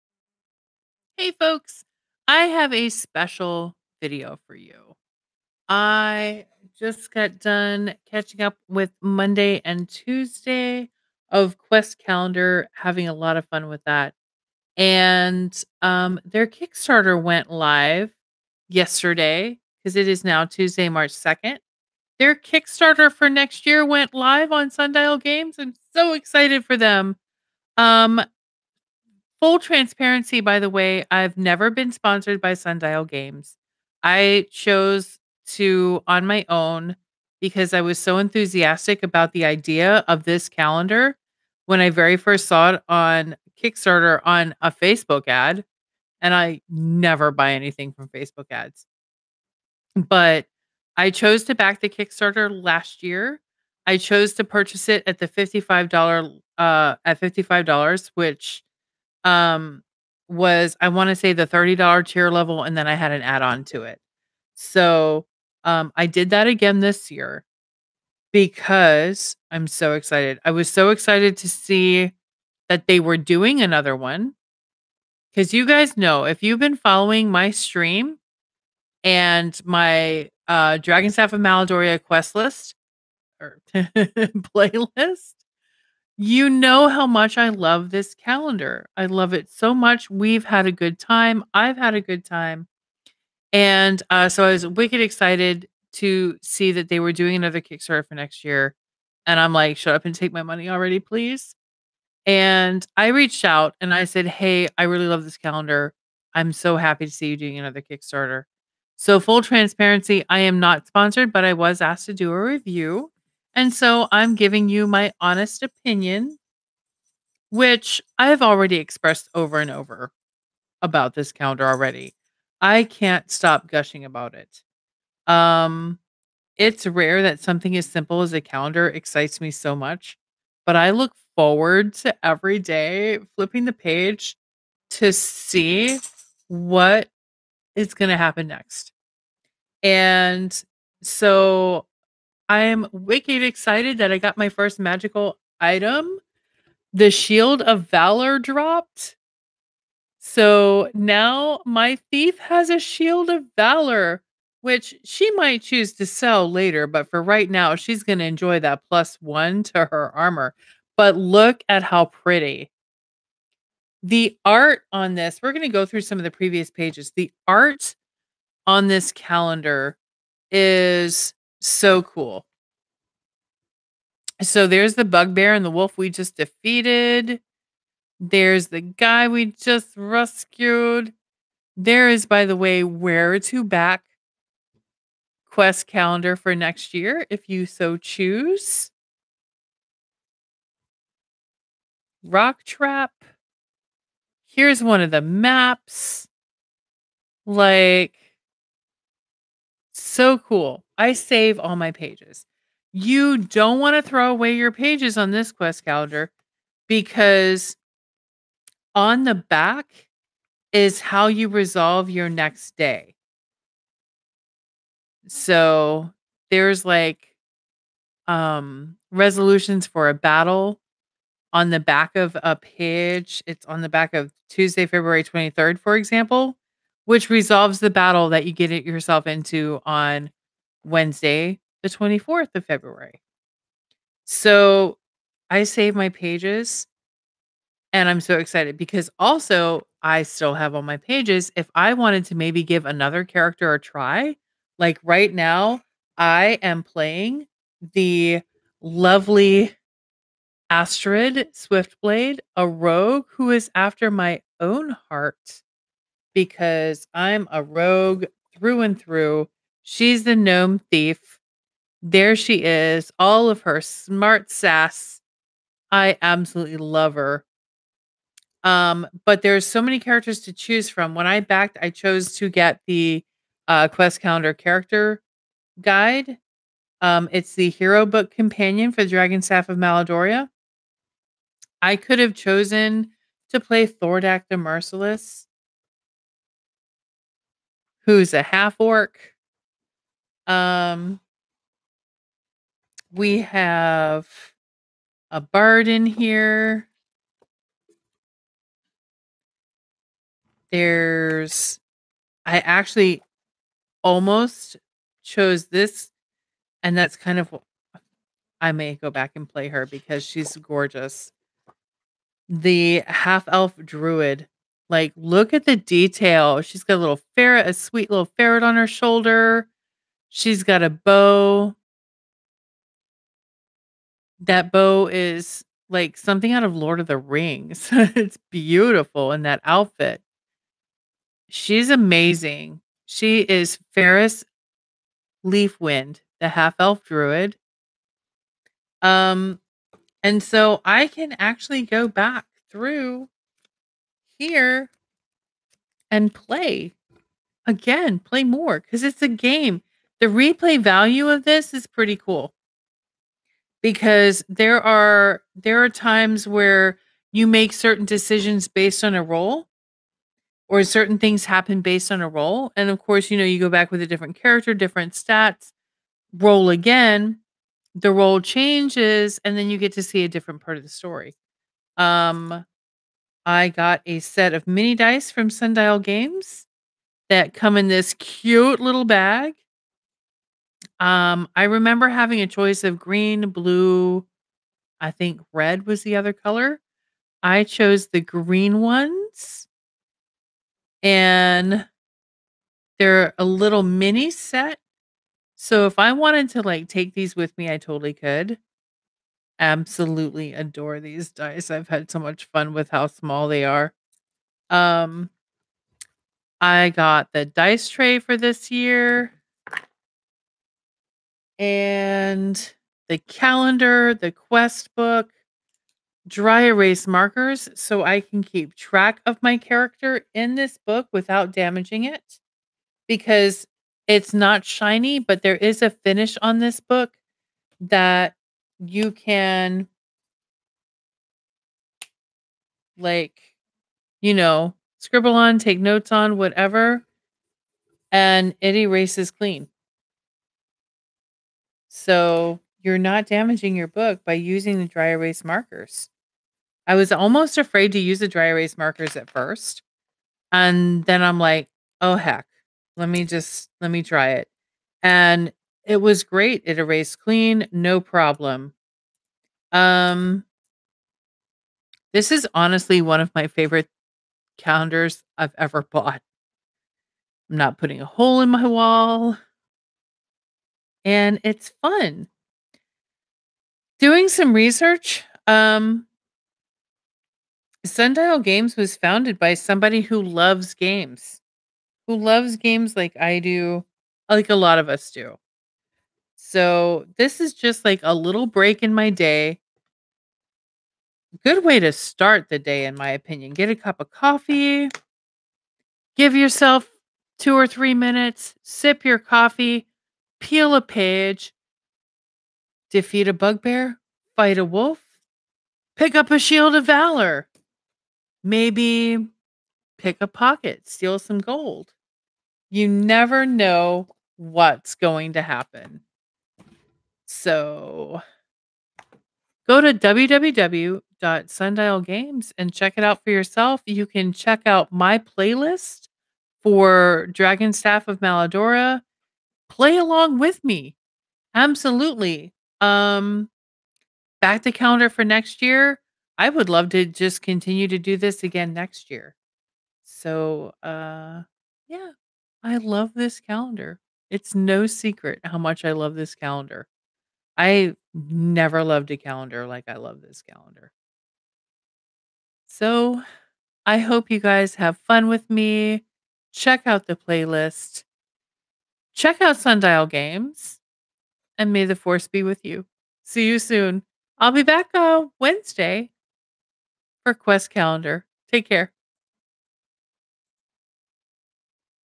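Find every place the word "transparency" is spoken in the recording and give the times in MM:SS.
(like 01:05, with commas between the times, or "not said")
00:29, 01:49.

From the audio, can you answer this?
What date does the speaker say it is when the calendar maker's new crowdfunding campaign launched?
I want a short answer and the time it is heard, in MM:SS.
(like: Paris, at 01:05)
March 2nd, at 00:20.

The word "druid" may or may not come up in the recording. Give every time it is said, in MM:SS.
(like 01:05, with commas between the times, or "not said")
05:13, 05:37.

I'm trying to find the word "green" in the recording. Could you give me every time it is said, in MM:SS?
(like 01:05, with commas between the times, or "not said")
06:22, 06:28.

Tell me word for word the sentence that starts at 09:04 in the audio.
It's no secret how much I love this calendar.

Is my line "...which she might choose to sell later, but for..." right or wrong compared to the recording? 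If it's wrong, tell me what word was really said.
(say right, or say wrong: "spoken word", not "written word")
right.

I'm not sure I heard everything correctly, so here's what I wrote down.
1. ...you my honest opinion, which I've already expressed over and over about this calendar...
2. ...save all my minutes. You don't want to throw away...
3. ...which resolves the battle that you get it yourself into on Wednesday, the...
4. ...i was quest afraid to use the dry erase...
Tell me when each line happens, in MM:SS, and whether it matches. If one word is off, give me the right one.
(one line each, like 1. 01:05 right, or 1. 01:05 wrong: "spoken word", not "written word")
1. 01:54 right
2. 03:21 wrong: "pages", not "minutes"
3. 03:47 right
4. 07:26 wrong: "almost", not "quest".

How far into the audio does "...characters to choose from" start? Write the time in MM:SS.
04:29.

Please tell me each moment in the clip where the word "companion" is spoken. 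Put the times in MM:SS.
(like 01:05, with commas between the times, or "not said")
04:38.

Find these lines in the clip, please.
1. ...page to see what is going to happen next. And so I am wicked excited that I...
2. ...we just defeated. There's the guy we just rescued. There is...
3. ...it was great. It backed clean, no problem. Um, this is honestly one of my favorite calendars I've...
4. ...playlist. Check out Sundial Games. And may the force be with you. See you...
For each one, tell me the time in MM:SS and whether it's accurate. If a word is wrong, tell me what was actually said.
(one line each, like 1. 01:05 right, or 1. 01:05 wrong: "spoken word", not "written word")
1. 02:13 right
2. 02:55 right
3. 07:35 wrong: "erased", not "backed"
4. 09:17 right.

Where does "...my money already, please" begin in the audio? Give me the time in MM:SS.
01:40.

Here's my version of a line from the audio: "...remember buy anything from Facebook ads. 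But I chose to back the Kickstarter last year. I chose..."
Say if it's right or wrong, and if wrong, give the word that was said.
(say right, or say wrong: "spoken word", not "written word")
wrong: "never", not "remember".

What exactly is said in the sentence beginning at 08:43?
You can check out my playlist for Dragon Staff of Maladoria.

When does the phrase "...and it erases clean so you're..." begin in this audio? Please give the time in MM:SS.
07:18.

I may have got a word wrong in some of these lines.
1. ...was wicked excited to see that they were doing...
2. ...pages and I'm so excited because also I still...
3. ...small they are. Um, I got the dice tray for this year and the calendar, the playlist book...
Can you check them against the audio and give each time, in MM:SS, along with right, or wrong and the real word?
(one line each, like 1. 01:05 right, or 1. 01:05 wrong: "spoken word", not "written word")
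1. 01:34 right
2. 03:56 right
3. 06:43 wrong: "quest", not "playlist".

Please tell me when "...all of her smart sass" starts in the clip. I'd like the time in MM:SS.
04:23.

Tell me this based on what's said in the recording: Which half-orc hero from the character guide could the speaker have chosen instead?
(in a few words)
Thordak the Merciless.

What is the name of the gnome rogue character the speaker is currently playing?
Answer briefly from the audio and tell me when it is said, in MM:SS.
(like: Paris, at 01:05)
Astrid Swiftblade, at 04:10.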